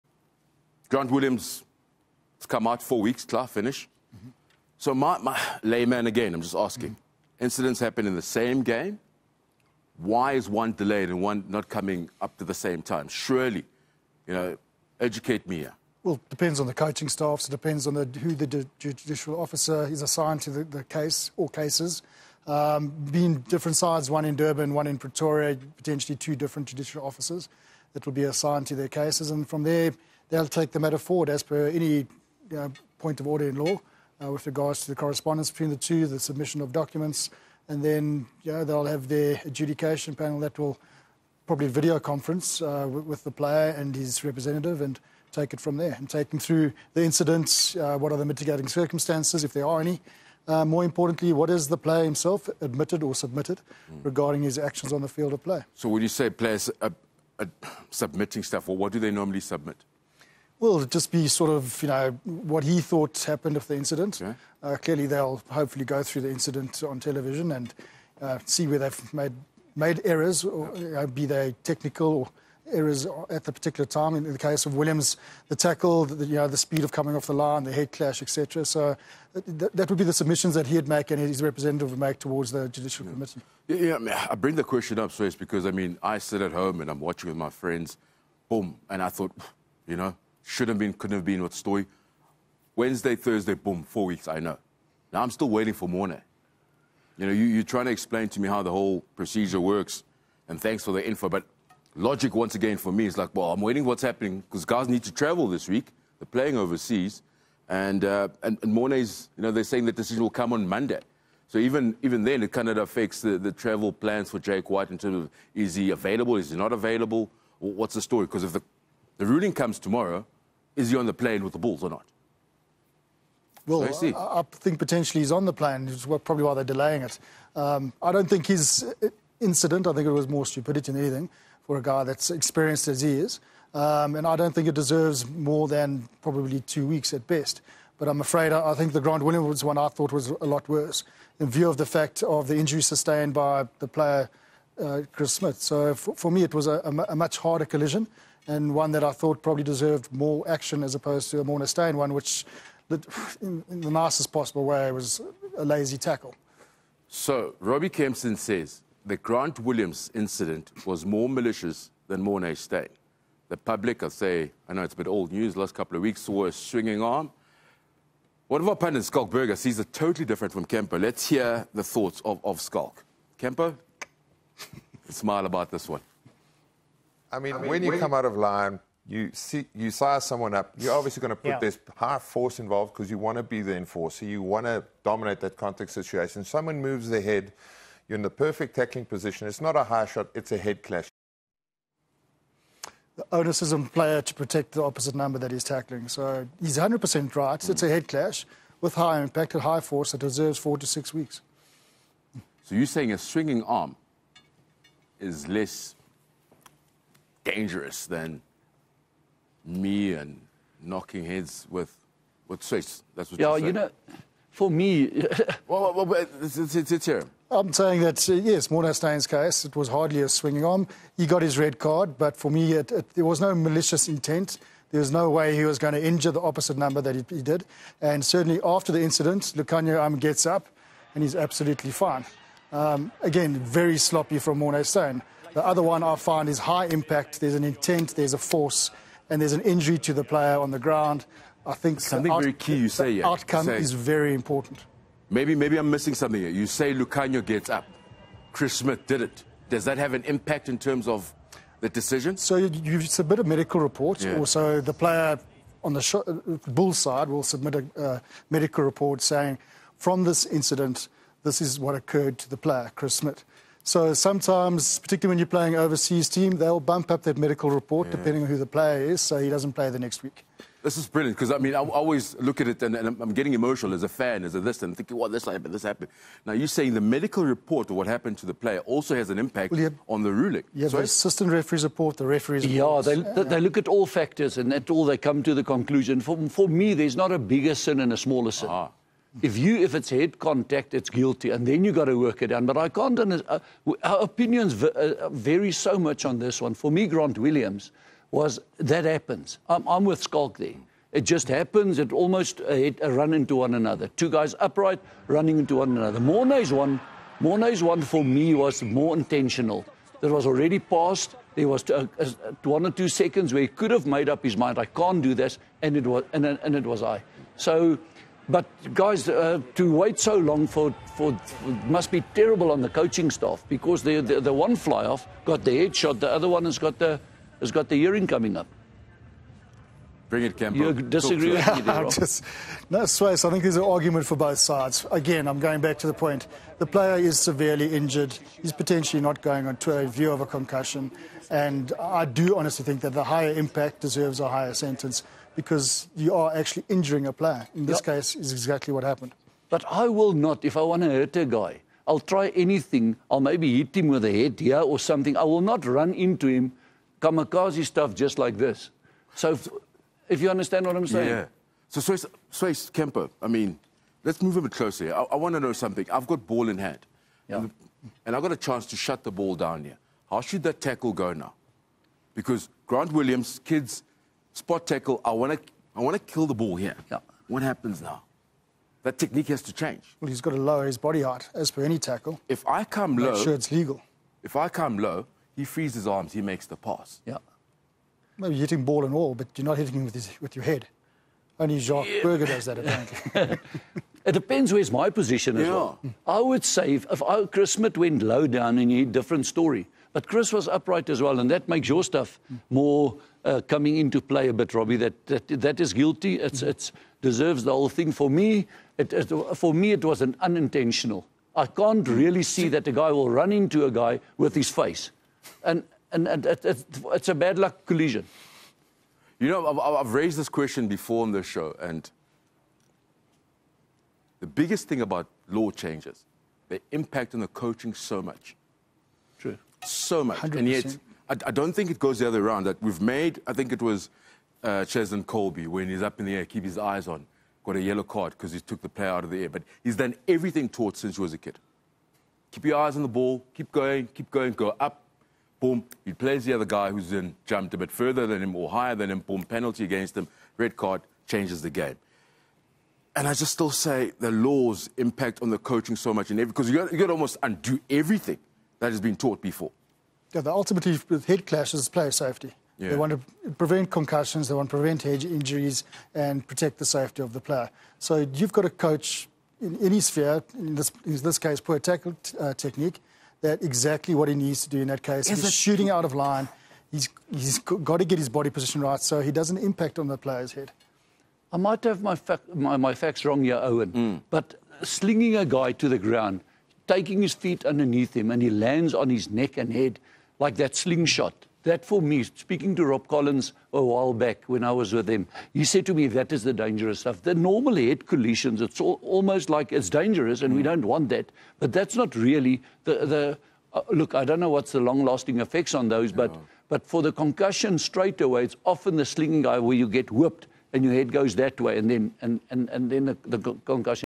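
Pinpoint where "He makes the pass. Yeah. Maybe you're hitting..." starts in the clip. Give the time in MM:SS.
06:26.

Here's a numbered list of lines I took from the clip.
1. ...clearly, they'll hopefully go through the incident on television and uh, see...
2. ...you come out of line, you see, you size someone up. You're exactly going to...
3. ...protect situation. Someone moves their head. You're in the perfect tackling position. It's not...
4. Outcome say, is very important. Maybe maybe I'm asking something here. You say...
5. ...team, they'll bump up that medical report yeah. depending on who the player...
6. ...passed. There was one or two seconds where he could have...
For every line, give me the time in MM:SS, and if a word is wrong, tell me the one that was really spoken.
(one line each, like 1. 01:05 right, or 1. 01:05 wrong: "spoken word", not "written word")
1. 01:04 right
2. 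02:57 wrong: "obviously", not "exactly"
3. 03:05 wrong: "contact", not "protect"
4. 04:03 wrong: "missing", not "asking"
5. 04:26 right
6. 05:10 right.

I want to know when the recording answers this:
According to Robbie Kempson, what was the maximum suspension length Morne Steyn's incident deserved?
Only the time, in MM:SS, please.
02:16.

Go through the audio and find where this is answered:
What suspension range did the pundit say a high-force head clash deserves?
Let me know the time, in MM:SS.
03:20.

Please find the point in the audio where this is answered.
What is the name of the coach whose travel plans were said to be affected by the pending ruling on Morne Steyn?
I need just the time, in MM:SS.
01:54.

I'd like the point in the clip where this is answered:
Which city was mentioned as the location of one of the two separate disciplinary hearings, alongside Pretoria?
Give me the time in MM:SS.
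00:24.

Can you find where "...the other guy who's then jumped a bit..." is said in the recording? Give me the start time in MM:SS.
07:26.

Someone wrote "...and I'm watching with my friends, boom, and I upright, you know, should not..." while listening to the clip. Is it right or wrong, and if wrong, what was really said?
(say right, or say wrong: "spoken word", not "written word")
wrong: "thought", not "upright".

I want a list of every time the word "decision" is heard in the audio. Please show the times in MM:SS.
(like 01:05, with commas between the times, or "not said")
01:49, 04:11.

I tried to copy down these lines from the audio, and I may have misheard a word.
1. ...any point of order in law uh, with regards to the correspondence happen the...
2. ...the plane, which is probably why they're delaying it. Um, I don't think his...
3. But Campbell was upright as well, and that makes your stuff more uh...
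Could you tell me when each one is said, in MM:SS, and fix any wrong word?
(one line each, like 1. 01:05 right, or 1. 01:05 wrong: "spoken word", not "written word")
1. 00:31 wrong: "between", not "happen"
2. 02:05 right
3. 06:40 wrong: "Chris", not "Campbell".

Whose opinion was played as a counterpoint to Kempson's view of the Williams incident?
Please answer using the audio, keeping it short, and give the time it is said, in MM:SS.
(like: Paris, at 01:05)
Schalk Burger, at 02:49.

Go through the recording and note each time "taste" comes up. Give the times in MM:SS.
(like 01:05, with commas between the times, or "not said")
not said.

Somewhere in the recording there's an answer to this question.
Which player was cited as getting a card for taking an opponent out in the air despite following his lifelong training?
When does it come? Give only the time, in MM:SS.
07:14.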